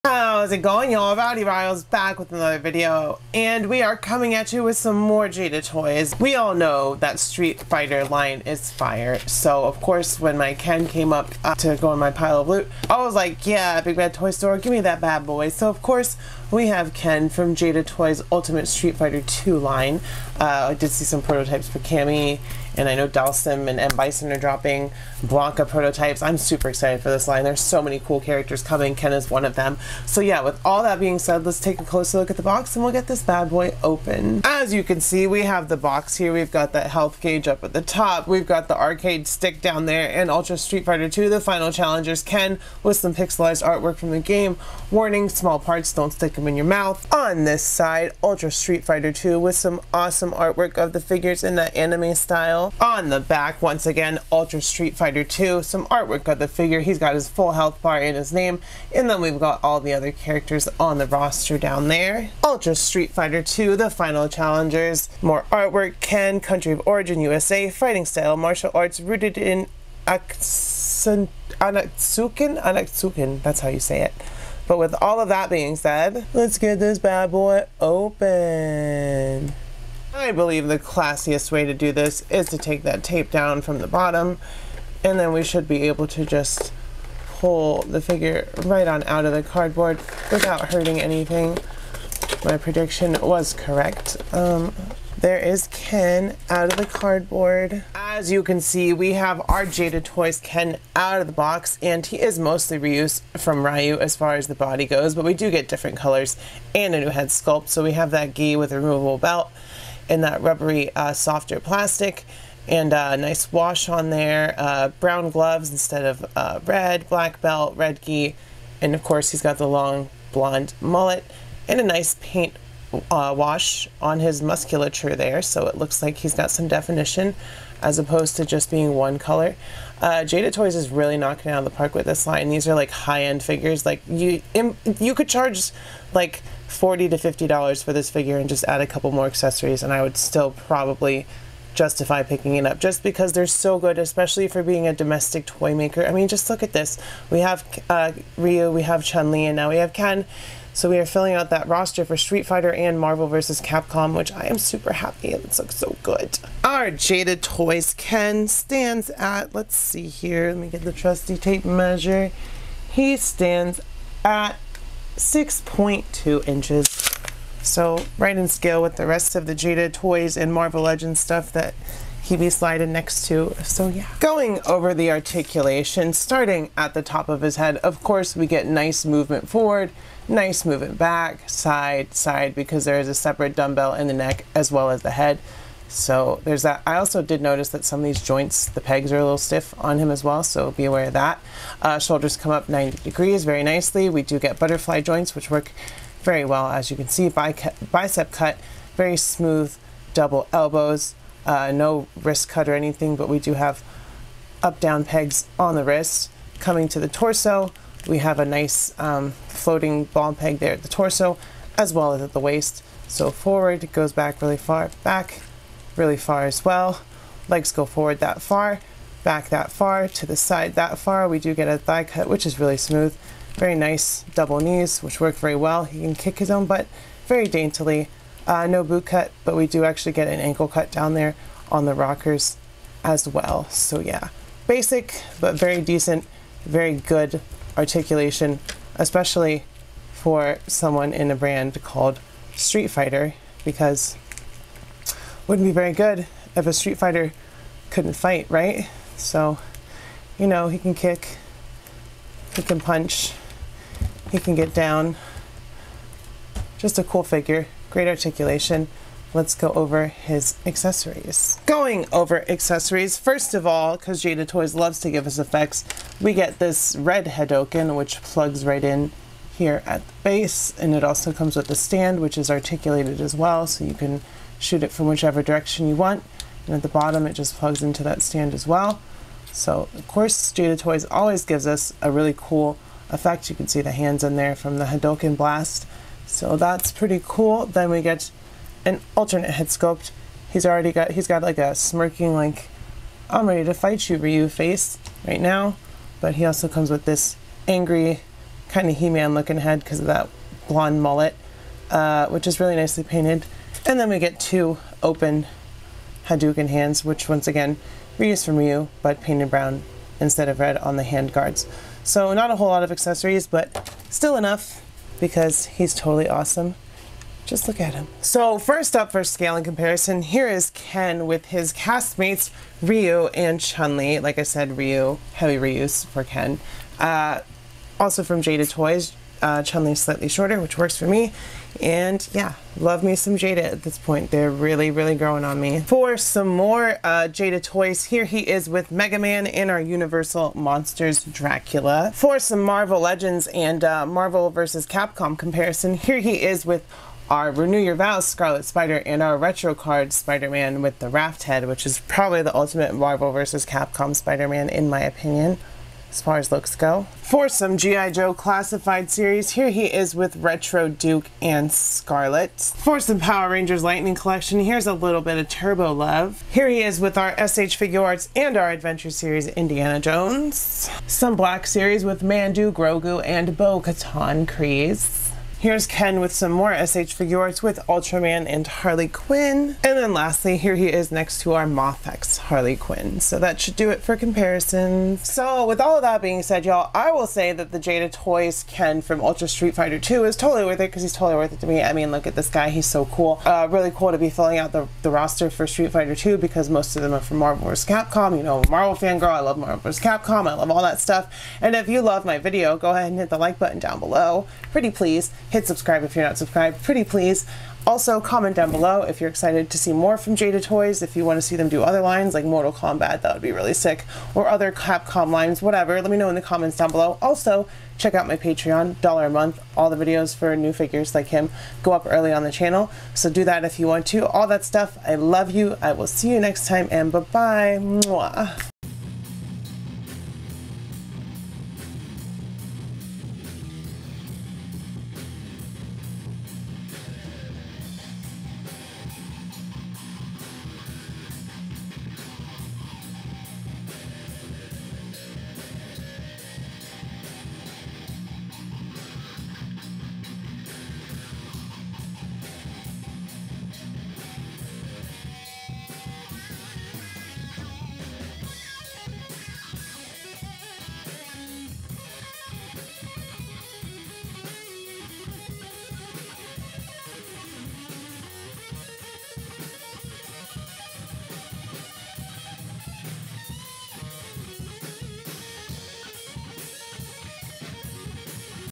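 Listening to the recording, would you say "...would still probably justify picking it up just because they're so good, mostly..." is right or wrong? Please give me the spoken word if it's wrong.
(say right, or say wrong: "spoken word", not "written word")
wrong: "especially", not "mostly".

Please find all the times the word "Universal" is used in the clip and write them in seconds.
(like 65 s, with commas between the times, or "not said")
339 s.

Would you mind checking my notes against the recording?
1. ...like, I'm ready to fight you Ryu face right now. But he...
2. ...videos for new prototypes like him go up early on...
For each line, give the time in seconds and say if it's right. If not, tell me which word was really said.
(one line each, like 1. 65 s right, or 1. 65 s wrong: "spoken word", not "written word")
1. 292 s right
2. 419 s wrong: "figures", not "prototypes".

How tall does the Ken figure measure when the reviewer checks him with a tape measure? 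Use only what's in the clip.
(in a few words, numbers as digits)
6.2 inches.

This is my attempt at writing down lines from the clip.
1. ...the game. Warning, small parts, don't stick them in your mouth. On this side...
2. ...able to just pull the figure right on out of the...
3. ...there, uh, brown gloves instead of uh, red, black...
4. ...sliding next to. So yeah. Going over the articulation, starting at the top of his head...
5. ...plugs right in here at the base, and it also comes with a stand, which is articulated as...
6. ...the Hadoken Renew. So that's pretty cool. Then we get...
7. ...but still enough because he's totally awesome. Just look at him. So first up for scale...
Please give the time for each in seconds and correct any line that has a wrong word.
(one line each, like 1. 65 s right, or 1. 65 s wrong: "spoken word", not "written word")
1. 44 s right
2. 85 s right
3. 114 s right
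4. 172 s right
5. 268 s right
6. 284 s wrong: "Blast", not "Renew"
7. 313 s right.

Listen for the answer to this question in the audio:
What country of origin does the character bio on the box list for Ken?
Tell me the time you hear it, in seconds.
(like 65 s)
67 s.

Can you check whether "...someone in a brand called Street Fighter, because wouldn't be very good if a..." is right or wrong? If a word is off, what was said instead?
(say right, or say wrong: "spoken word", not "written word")
right.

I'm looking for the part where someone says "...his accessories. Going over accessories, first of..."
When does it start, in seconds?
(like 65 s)
260 s.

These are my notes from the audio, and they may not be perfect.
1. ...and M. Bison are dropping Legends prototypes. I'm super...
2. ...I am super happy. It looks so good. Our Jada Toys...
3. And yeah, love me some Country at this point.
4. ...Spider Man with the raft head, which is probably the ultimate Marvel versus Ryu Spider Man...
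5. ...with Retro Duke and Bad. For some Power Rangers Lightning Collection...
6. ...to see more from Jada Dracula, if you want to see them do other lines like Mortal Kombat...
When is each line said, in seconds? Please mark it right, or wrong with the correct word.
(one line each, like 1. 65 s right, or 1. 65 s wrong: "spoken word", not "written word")
1. 23 s wrong: "Blanka", not "Legends"
2. 154 s right
3. 331 s wrong: "Jada", not "Country"
4. 350 s wrong: "Capcom", not "Ryu"
5. 360 s wrong: "Scarlett", not "Bad"
6. 409 s wrong: "Toys", not "Dracula".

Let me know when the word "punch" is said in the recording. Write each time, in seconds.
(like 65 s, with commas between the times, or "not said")
252 s.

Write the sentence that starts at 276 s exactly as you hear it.
And at the bottom, it just plugs into that stand as well.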